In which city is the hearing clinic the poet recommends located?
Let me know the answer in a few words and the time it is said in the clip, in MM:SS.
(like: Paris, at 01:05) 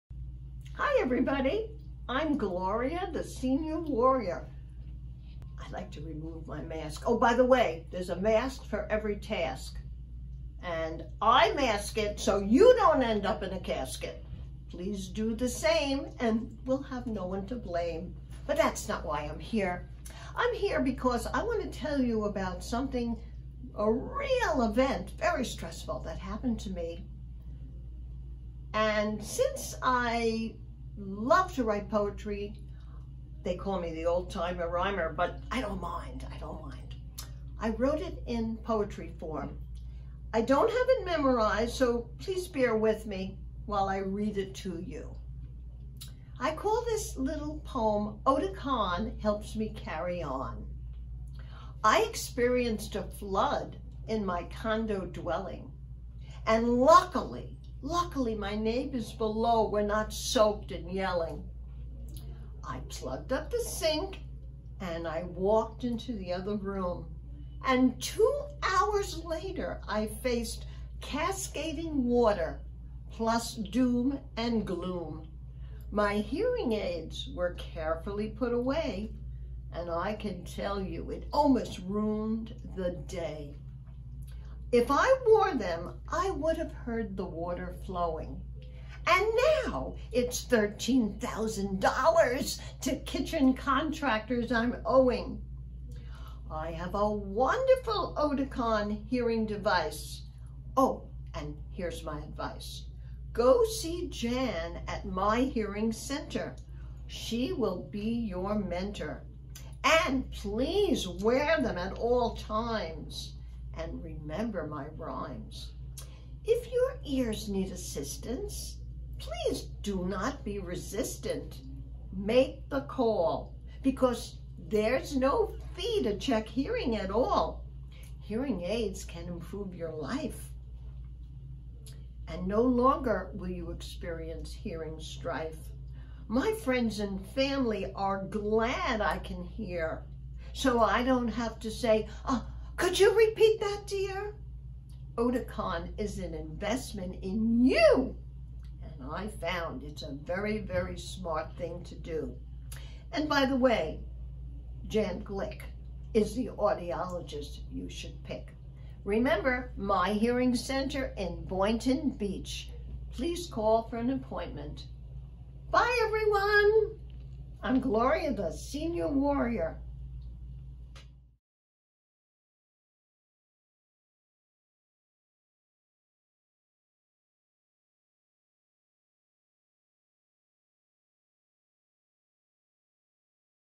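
Boynton Beach, at 02:41.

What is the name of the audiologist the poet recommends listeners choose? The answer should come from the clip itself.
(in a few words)
Jan Glick.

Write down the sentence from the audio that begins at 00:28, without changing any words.
And since I love to write poetry.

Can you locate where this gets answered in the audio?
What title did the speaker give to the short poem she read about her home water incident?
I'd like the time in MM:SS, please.
00:48.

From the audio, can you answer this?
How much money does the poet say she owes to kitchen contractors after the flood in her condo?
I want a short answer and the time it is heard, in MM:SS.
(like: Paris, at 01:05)
$13,000, at 01:30.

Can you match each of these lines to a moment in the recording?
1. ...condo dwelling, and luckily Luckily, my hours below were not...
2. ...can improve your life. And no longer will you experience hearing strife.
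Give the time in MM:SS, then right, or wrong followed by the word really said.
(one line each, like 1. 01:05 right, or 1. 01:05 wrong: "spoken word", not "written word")
1. 00:54 wrong: "neighbors", not "hours"
2. 02:09 right.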